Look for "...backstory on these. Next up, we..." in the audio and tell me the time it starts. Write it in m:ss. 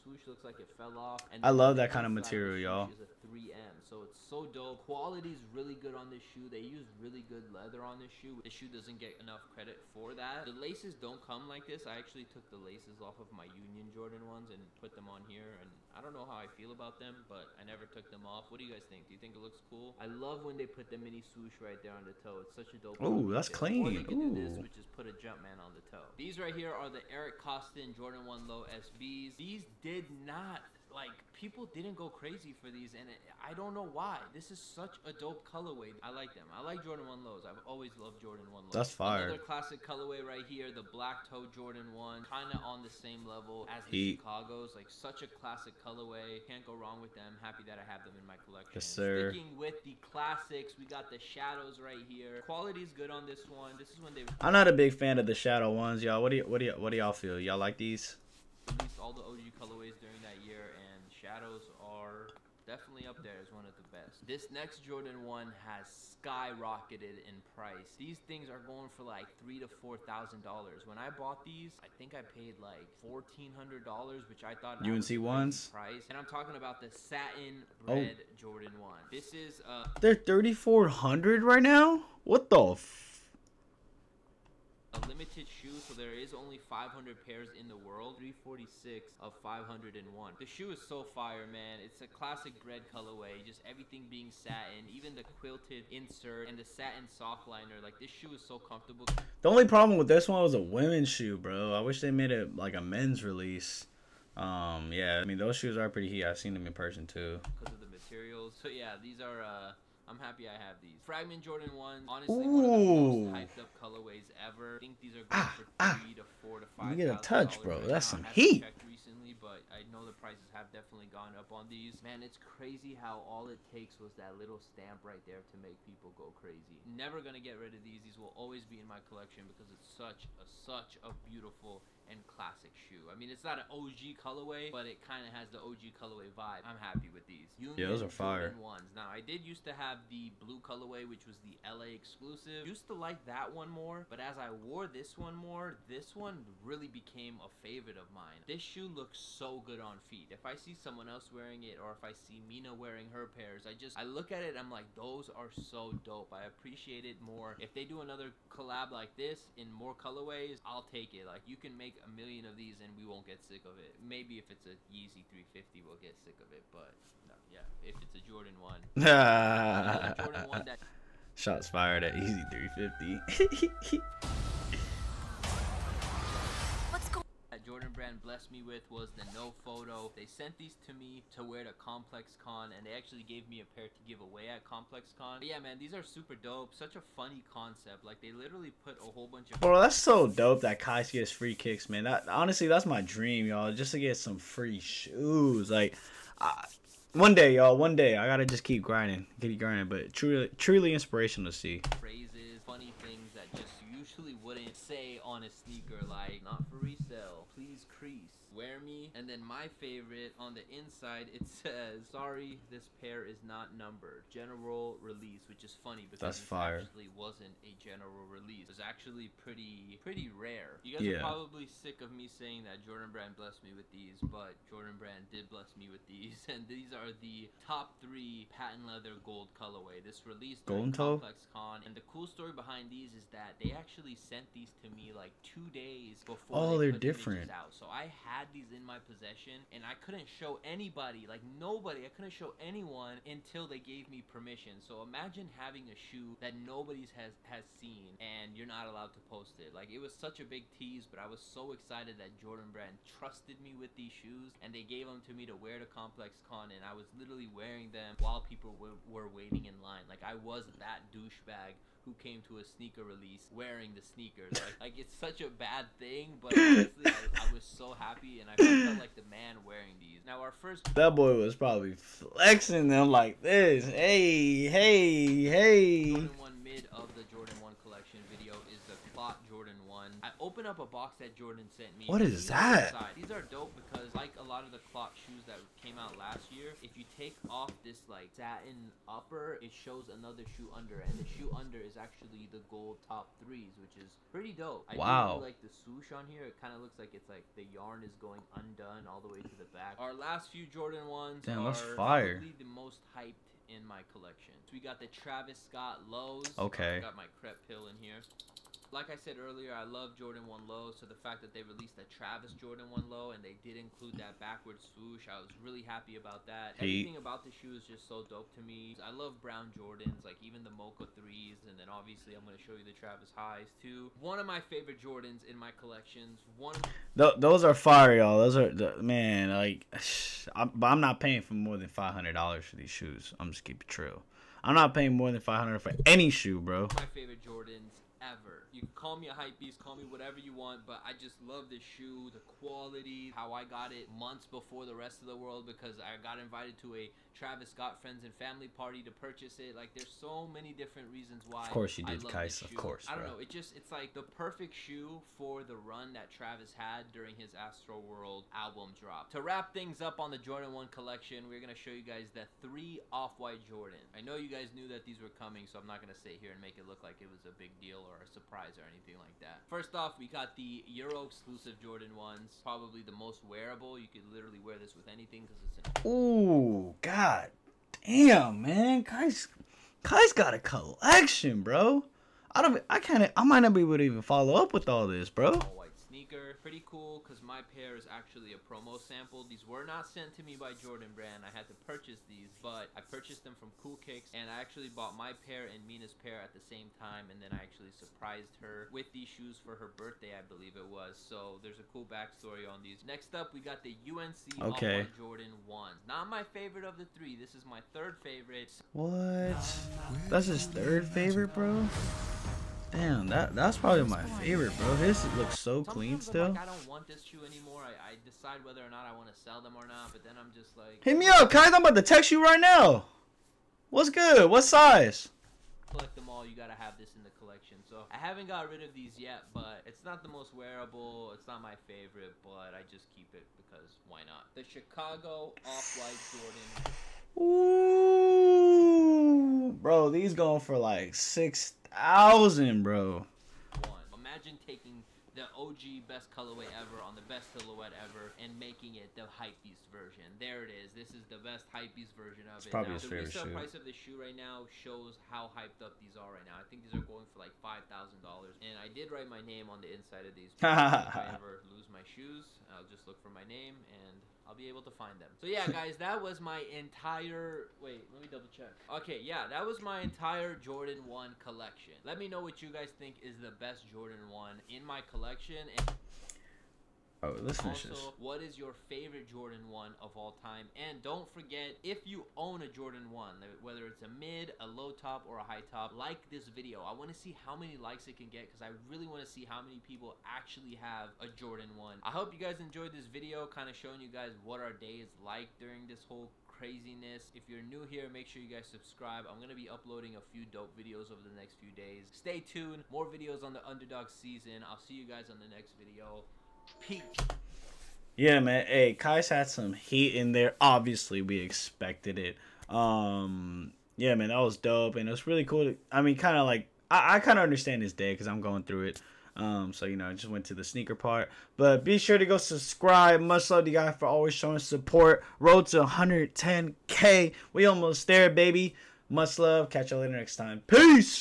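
6:42.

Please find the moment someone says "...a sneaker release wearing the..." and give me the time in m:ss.
4:22.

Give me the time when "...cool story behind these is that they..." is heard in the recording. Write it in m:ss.
3:52.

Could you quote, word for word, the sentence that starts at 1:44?
Um, yeah, I mean, those shoes are pretty heat.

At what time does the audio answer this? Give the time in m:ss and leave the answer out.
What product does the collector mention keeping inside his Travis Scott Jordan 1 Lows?
5:07.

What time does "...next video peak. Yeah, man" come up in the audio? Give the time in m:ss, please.
8:25.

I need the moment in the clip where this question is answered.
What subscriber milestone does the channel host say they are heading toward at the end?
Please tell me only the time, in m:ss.
8:45.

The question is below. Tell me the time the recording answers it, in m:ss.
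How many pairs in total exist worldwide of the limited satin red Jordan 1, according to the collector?
1:26.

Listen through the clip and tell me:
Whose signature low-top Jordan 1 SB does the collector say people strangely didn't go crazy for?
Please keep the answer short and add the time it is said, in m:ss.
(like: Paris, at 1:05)
Eric Koston, at 0:27.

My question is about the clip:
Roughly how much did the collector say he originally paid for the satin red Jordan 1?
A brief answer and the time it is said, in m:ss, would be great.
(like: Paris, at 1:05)
$1,400, at 1:13.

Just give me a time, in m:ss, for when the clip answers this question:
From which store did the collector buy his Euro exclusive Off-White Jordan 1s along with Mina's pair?
6:33.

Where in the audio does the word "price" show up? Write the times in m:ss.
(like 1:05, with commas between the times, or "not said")
1:07, 1:15, 2:00, 7:33.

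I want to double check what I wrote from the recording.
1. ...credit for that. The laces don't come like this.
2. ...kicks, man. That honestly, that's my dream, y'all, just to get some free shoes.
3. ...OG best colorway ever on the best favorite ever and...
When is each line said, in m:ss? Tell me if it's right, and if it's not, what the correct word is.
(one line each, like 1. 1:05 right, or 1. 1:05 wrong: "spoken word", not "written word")
1. 0:09 right
2. 3:11 right
3. 7:25 wrong: "silhouette", not "favorite".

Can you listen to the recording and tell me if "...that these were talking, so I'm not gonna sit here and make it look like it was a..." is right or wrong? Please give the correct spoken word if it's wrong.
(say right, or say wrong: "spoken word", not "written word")
wrong: "coming", not "talking".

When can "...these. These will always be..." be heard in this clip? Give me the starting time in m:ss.
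2:07.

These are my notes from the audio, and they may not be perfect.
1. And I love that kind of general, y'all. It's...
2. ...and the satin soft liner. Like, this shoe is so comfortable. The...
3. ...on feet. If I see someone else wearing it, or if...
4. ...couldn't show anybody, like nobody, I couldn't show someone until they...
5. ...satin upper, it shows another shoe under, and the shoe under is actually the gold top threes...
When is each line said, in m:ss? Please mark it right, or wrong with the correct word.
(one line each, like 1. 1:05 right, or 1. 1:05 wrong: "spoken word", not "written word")
1. 0:01 wrong: "material", not "general"
2. 1:36 right
3. 2:29 right
4. 4:00 wrong: "anyone", not "someone"
5. 4:48 right.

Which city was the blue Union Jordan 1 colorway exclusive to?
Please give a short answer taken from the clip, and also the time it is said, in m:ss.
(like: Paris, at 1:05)
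LA, at 2:21.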